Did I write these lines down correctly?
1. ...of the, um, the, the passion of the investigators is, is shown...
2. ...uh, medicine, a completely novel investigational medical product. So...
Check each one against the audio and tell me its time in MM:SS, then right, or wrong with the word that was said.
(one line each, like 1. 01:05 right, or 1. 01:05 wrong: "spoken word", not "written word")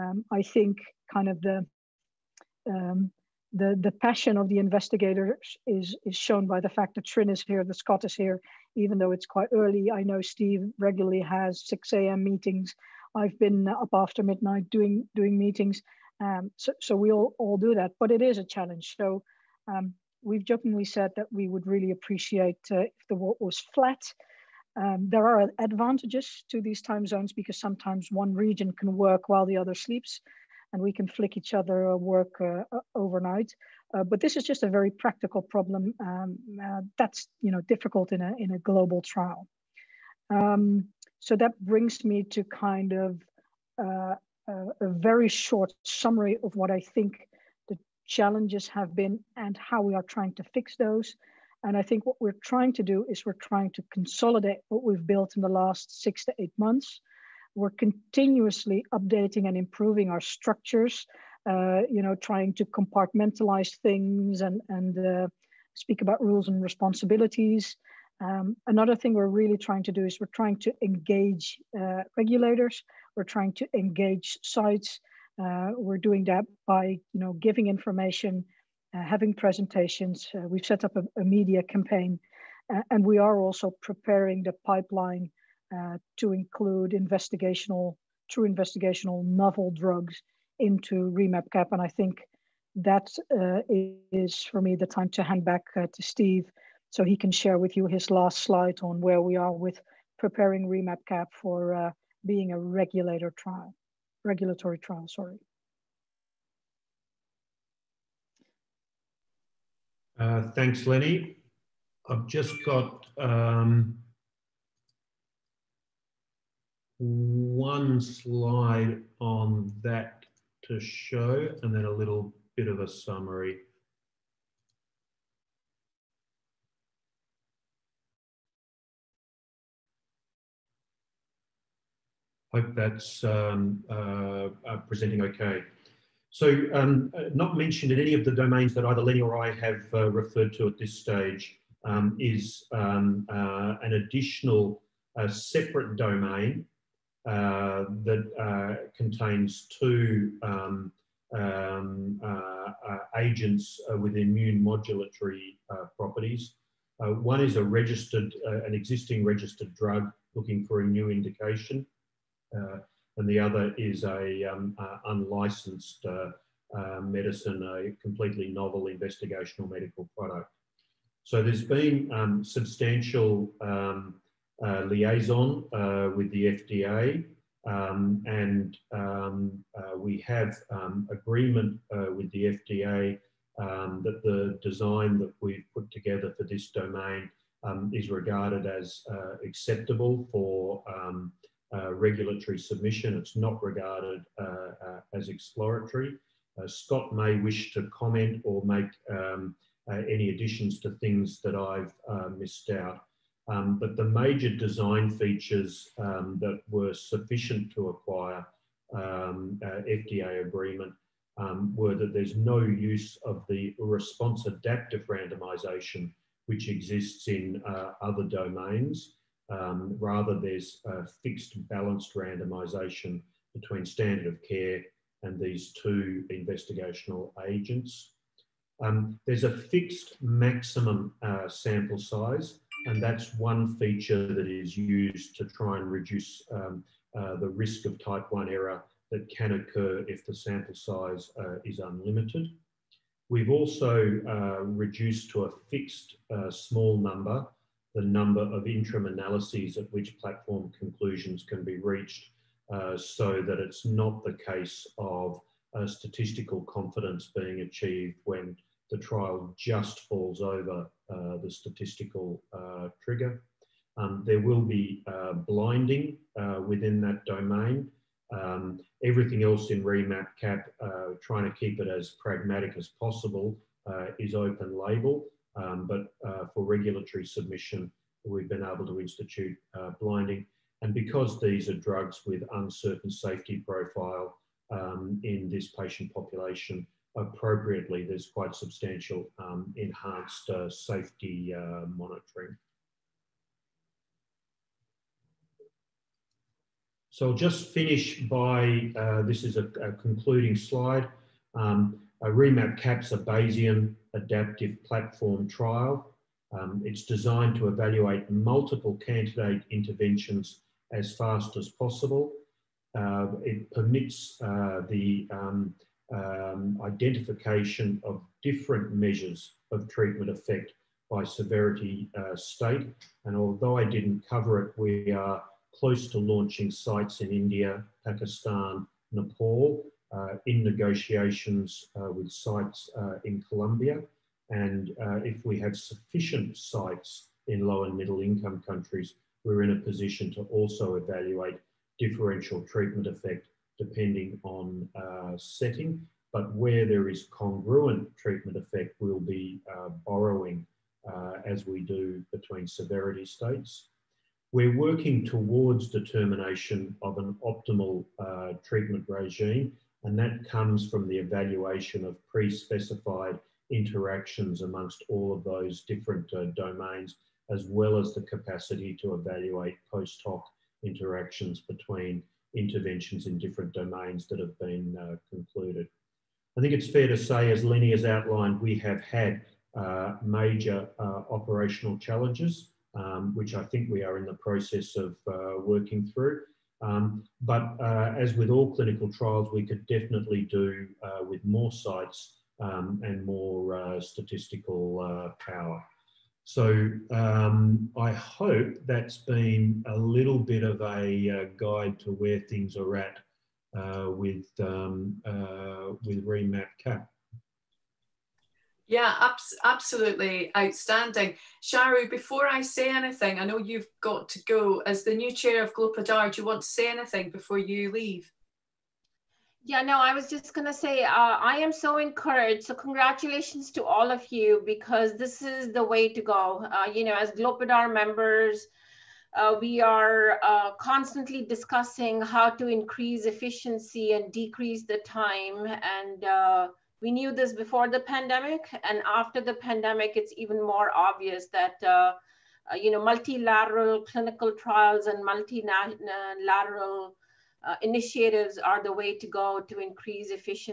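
1. 00:01 right
2. 02:46 right.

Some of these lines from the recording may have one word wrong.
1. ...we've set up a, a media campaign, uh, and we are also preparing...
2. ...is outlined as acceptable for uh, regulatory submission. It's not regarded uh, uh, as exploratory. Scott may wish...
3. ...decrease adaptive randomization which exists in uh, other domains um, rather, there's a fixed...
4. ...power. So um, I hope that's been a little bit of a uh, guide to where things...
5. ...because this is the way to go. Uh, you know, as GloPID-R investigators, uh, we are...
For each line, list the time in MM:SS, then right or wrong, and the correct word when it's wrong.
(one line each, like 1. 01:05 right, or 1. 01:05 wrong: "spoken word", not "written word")
1. 01:20 right
2. 03:07 wrong: "regarded", not "outlined"
3. 03:33 wrong: "response", not "decrease"
4. 06:35 right
5. 07:04 wrong: "members", not "investigators".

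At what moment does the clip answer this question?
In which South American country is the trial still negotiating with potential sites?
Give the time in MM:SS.
05:33.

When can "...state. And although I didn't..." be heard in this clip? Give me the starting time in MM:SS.
05:22.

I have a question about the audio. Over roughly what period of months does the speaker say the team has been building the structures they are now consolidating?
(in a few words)
6 to 8 months.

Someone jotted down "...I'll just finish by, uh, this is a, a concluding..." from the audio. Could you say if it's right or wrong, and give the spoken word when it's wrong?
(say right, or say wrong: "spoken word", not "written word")
right.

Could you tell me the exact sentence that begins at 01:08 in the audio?
Um, another thing we're really trying to do is we're trying to engage uh, regulators, we're trying to engage sites.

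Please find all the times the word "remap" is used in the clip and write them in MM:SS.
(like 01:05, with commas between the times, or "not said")
01:31, 01:40, 04:29, 05:02, 06:46.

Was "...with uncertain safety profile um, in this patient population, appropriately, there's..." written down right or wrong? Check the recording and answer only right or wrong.
right.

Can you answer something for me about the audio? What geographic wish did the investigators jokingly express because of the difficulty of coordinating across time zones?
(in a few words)
The world was flat.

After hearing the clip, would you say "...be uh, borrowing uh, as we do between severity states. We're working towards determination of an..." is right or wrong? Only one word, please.
right.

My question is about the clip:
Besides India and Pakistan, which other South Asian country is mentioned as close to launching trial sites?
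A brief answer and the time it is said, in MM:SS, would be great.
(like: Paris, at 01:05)
Nepal, at 05:29.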